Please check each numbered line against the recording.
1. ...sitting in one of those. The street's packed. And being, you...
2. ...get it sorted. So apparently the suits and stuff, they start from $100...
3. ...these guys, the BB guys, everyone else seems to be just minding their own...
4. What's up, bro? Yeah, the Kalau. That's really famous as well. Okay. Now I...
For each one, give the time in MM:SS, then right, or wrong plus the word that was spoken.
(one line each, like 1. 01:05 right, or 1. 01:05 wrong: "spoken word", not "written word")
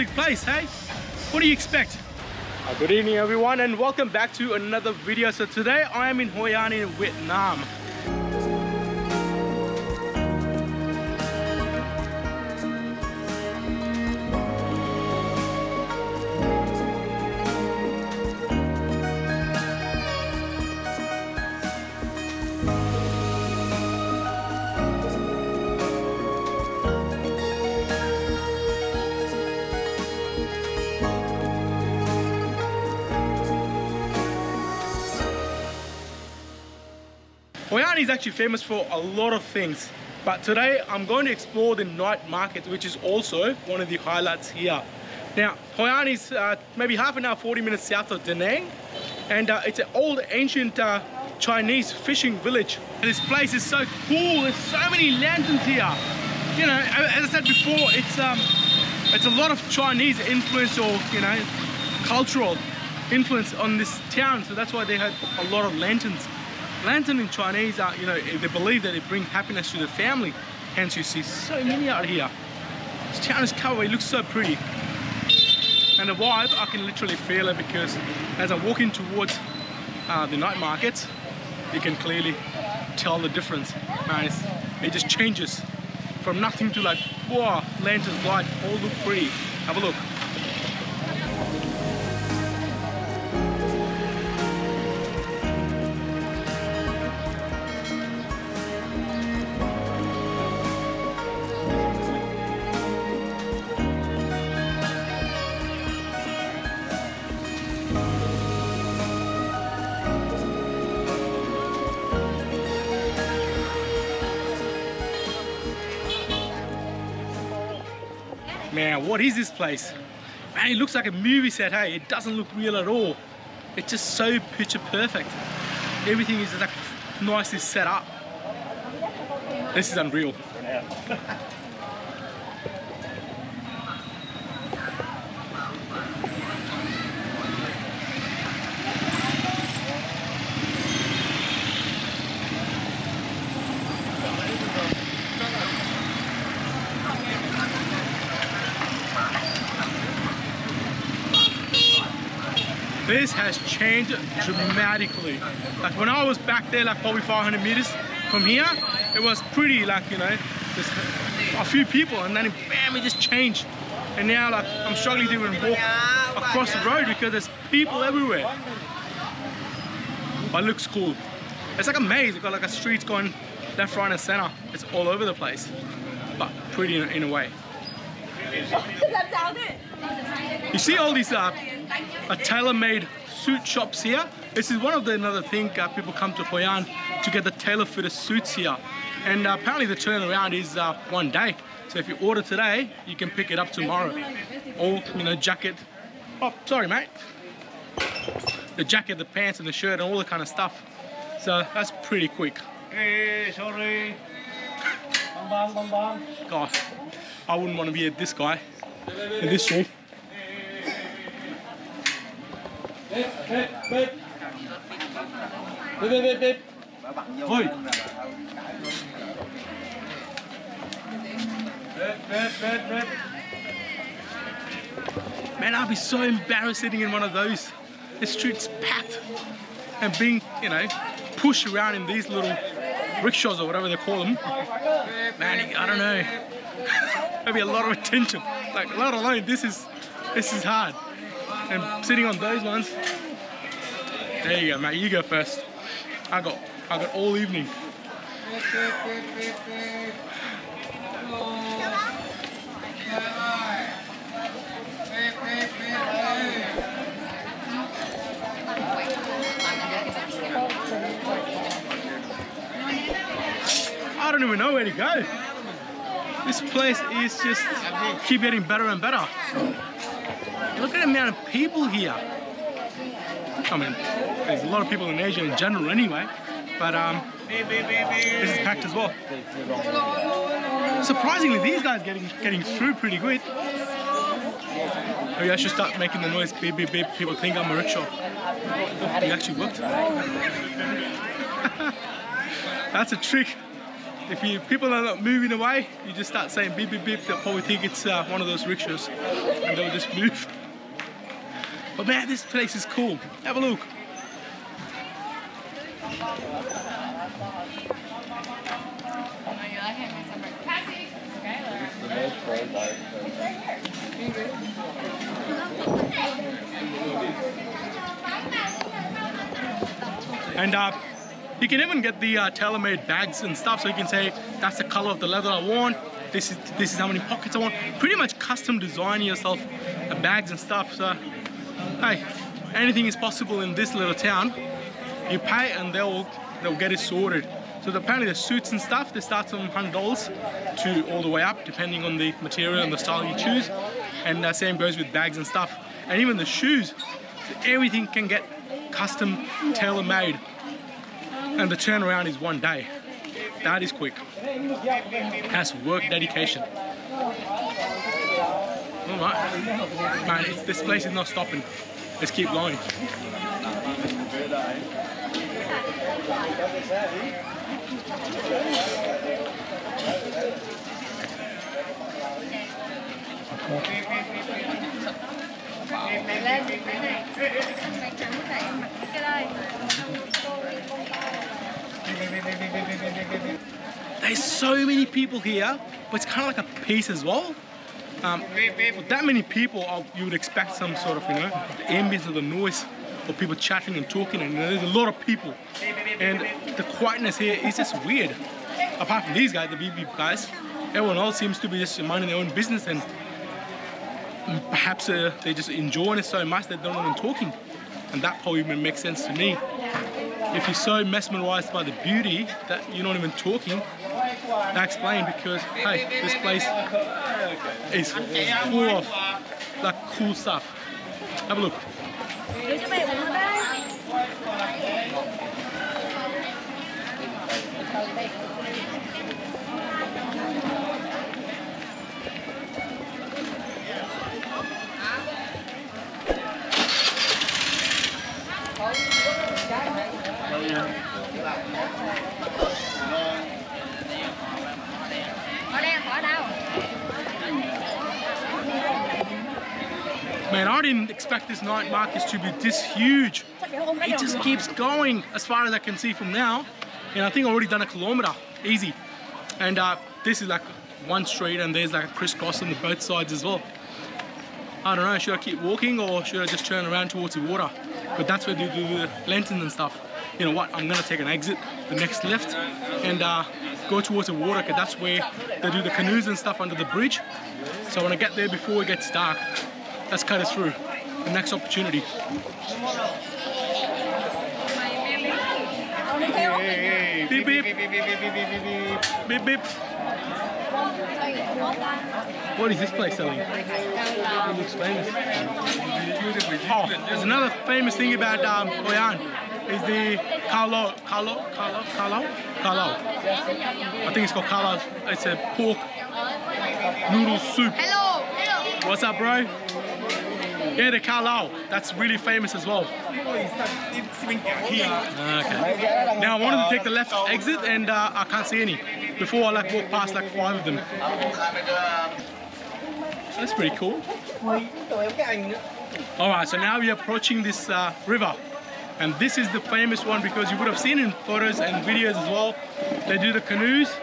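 1. 03:46 right
2. 05:36 right
3. 06:39 right
4. 08:28 right.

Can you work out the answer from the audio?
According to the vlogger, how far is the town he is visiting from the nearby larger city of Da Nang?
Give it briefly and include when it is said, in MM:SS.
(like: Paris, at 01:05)
half an hour, 40 minutes, at 00:46.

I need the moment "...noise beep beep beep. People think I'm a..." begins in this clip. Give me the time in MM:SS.
04:46.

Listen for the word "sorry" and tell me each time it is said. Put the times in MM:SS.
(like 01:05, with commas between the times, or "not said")
03:16, 03:23.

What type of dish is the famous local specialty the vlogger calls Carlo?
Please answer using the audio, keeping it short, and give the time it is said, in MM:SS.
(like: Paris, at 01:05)
pork noodle soup, at 08:25.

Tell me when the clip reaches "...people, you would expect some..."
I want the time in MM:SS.
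06:29.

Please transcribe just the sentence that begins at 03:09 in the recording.
And uh, apparently the turnaround is uh, one day.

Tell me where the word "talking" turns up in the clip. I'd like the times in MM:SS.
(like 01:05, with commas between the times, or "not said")
06:34, 06:47, 06:53.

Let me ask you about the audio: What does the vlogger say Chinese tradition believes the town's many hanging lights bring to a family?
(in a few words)
happiness.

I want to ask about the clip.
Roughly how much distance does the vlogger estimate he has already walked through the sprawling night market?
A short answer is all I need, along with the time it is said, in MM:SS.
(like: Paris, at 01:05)
a kilometer, at 07:37.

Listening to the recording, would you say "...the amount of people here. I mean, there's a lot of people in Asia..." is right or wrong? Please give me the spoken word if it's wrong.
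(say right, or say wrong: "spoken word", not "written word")
right.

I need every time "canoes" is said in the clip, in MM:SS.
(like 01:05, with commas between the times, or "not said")
07:55, 08:53.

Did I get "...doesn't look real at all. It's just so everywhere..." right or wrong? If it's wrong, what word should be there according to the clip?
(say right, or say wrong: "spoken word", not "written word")
wrong: "picture", not "everywhere".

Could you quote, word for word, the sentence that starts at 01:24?
Man, it just changes from nothing to like, wow, lanterns, light, all look pretty.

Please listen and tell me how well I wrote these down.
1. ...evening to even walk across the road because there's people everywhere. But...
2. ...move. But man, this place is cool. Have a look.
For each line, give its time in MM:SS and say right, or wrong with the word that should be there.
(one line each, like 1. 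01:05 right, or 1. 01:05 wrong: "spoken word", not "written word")
1. 02:44 wrong: "struggling", not "evening"
2. 05:00 right.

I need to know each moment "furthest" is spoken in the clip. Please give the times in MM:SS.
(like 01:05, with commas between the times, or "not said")
not said.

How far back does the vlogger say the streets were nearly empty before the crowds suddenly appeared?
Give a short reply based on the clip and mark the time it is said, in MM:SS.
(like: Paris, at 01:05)
500 meters, at 02:37.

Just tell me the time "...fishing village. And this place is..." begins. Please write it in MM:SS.
00:51.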